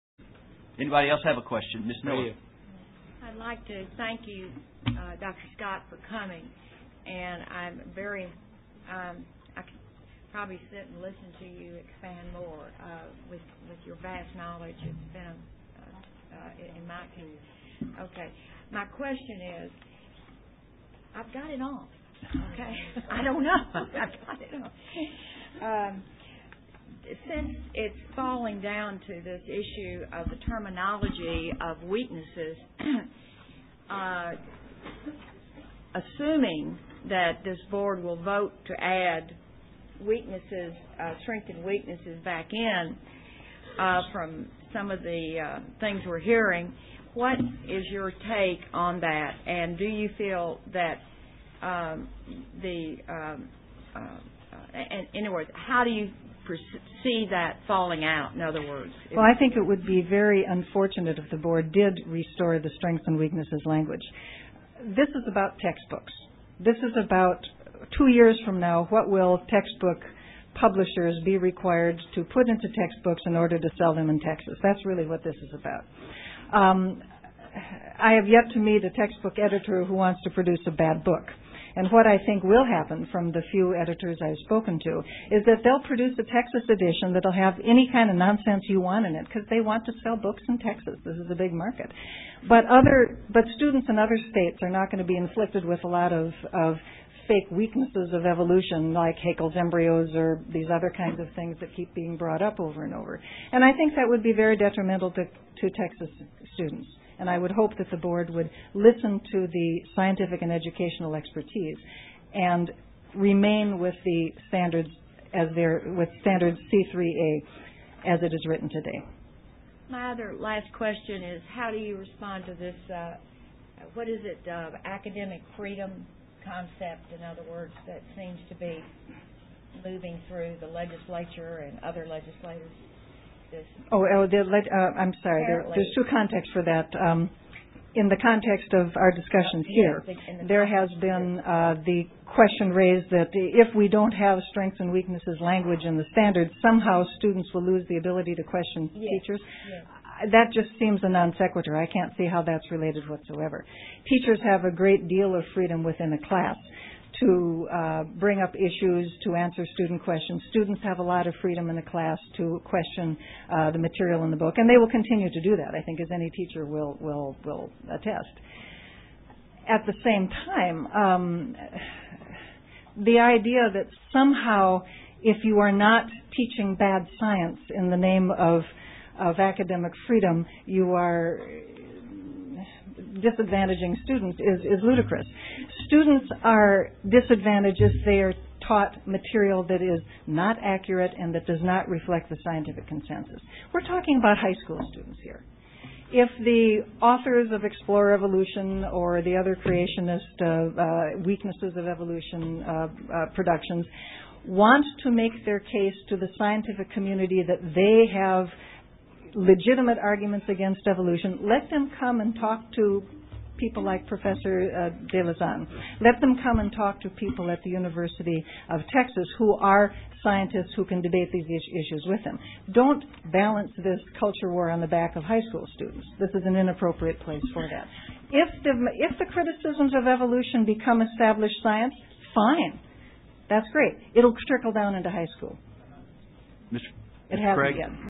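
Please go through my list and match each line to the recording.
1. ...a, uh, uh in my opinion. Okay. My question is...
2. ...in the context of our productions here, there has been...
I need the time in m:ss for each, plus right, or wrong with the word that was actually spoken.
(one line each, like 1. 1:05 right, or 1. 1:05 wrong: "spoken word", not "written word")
1. 0:15 right
2. 2:17 wrong: "discussions", not "productions".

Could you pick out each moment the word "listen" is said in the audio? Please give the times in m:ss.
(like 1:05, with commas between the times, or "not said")
0:10, 1:48.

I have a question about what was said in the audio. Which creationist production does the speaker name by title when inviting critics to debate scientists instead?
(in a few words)
Explore Evolution.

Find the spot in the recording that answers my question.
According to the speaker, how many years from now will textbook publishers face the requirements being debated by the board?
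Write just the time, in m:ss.
1:07.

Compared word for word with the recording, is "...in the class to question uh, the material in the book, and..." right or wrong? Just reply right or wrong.
right.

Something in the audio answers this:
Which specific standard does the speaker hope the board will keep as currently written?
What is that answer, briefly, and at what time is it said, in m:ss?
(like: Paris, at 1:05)
C3A, at 1:56.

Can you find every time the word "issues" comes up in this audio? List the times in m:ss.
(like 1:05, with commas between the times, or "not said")
0:29, 2:38, 3:41.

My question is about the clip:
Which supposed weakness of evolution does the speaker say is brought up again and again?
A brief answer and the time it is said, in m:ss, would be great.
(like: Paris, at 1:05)
Haeckel's embryos, at 1:39.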